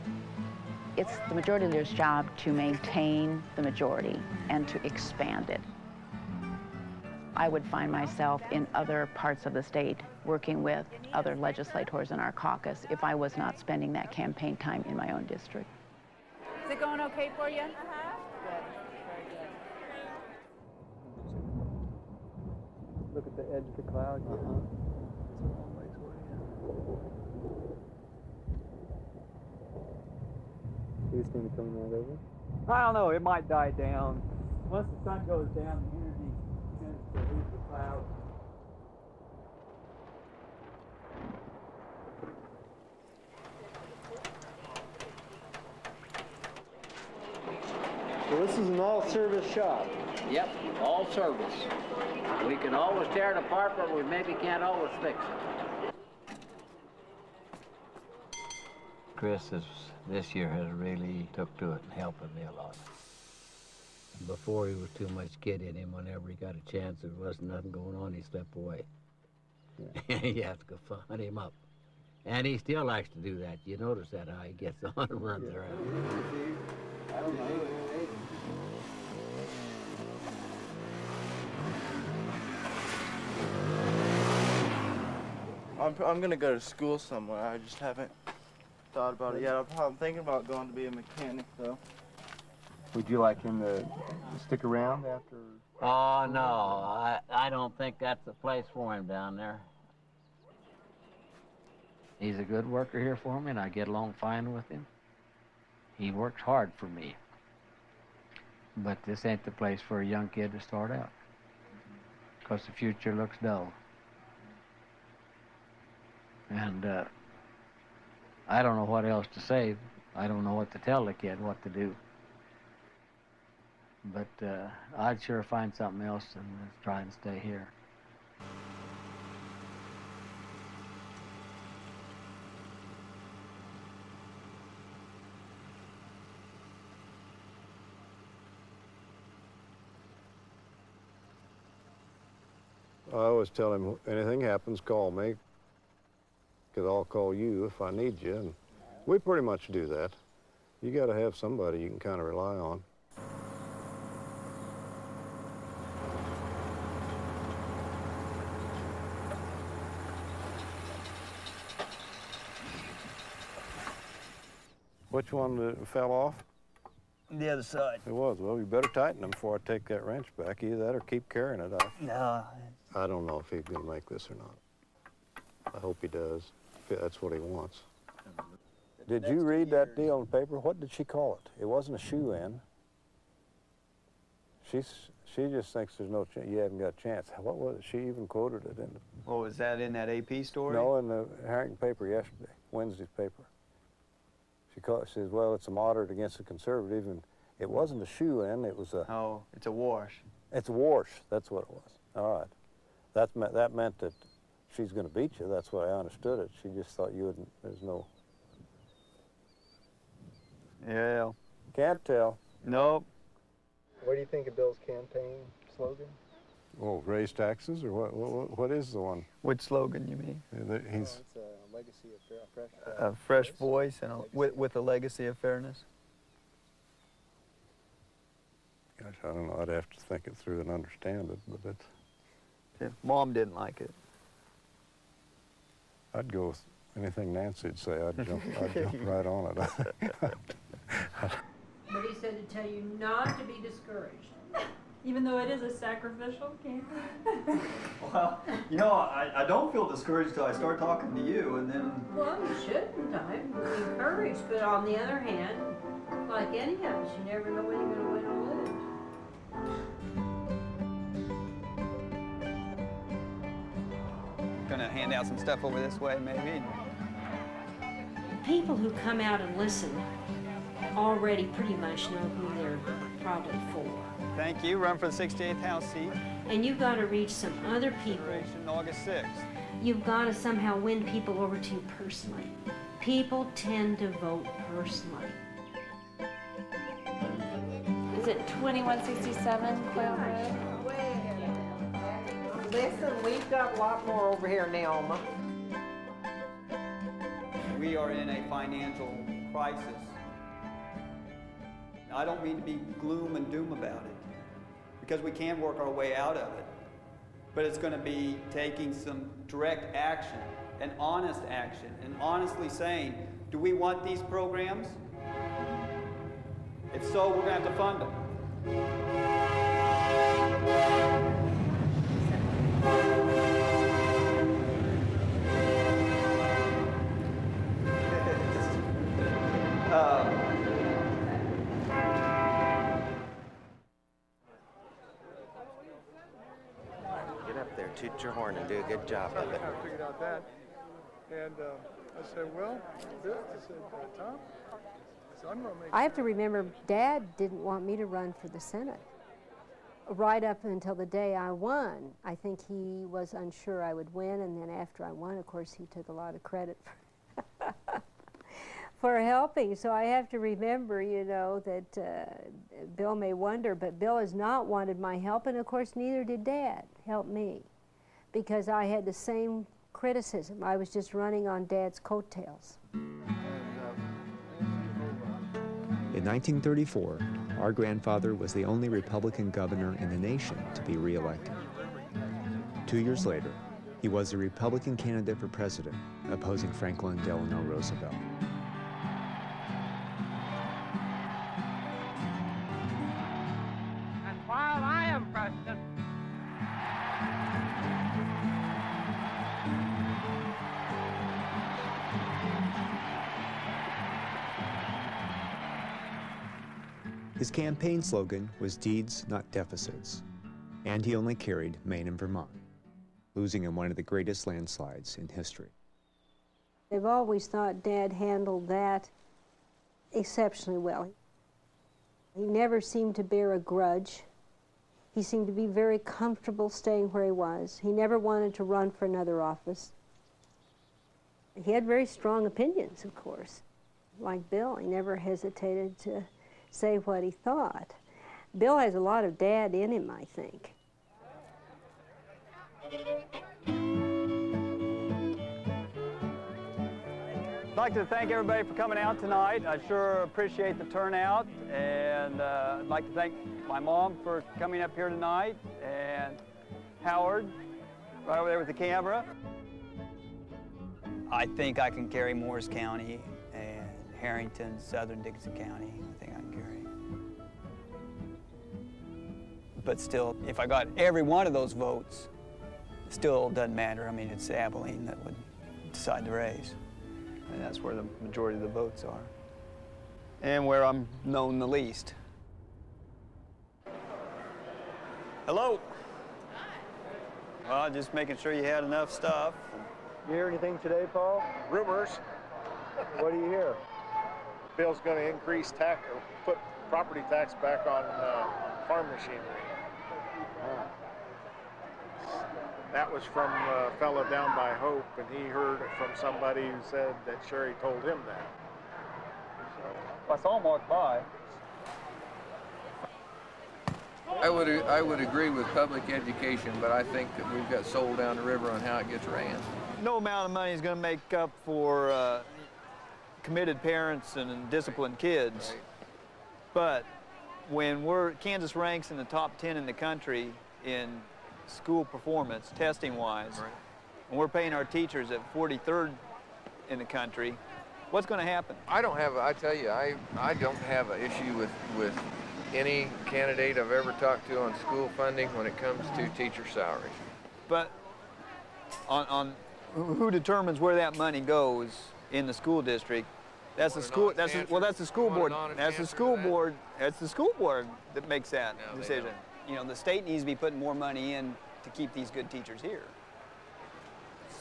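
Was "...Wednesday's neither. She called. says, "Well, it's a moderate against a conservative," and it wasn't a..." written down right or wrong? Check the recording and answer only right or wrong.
wrong.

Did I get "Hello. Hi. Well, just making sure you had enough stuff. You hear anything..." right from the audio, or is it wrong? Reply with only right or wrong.
right.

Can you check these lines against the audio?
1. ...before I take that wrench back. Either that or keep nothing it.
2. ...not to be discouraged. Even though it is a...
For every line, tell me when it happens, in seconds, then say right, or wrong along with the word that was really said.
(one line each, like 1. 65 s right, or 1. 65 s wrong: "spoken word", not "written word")
1. 169 s wrong: "carrying", not "nothing"
2. 242 s right.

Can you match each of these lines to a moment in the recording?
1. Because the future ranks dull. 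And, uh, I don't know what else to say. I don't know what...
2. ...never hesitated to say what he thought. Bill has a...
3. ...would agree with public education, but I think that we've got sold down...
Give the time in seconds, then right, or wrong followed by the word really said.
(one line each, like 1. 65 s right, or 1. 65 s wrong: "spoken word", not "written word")
1. 112 s wrong: "looks", not "ranks"
2. 434 s right
3. 515 s right.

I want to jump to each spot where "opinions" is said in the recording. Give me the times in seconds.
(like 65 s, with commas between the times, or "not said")
432 s.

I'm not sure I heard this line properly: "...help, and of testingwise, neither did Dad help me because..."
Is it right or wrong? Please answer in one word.
wrong.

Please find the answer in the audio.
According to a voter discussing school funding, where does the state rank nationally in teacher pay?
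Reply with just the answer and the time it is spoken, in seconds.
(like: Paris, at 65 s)
43rd, at 535 s.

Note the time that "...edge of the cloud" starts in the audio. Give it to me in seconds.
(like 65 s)
23 s.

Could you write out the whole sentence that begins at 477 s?
And that's where the majority of the votes are.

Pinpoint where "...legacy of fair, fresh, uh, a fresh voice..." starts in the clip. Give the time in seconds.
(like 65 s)
221 s.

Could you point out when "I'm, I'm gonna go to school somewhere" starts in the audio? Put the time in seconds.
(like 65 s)
85 s.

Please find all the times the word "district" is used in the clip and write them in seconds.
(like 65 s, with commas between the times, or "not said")
15 s, 552 s.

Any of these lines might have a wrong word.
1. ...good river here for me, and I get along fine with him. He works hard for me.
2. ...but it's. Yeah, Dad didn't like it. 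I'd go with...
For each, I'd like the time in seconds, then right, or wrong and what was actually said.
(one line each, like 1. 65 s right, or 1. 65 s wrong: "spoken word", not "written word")
1. 102 s wrong: "worker", not "river"
2. 231 s wrong: "Mom", not "Dad".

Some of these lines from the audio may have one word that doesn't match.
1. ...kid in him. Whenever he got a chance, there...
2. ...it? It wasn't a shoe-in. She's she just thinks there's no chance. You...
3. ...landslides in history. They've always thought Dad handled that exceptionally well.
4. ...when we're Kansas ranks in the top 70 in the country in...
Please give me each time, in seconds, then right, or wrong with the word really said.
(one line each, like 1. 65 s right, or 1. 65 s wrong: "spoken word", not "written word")
1. 65 s right
2. 181 s right
3. 414 s right
4. 527 s wrong: "10", not "70".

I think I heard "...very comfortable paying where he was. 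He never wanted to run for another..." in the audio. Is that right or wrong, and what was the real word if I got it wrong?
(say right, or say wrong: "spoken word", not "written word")
wrong: "staying", not "paying".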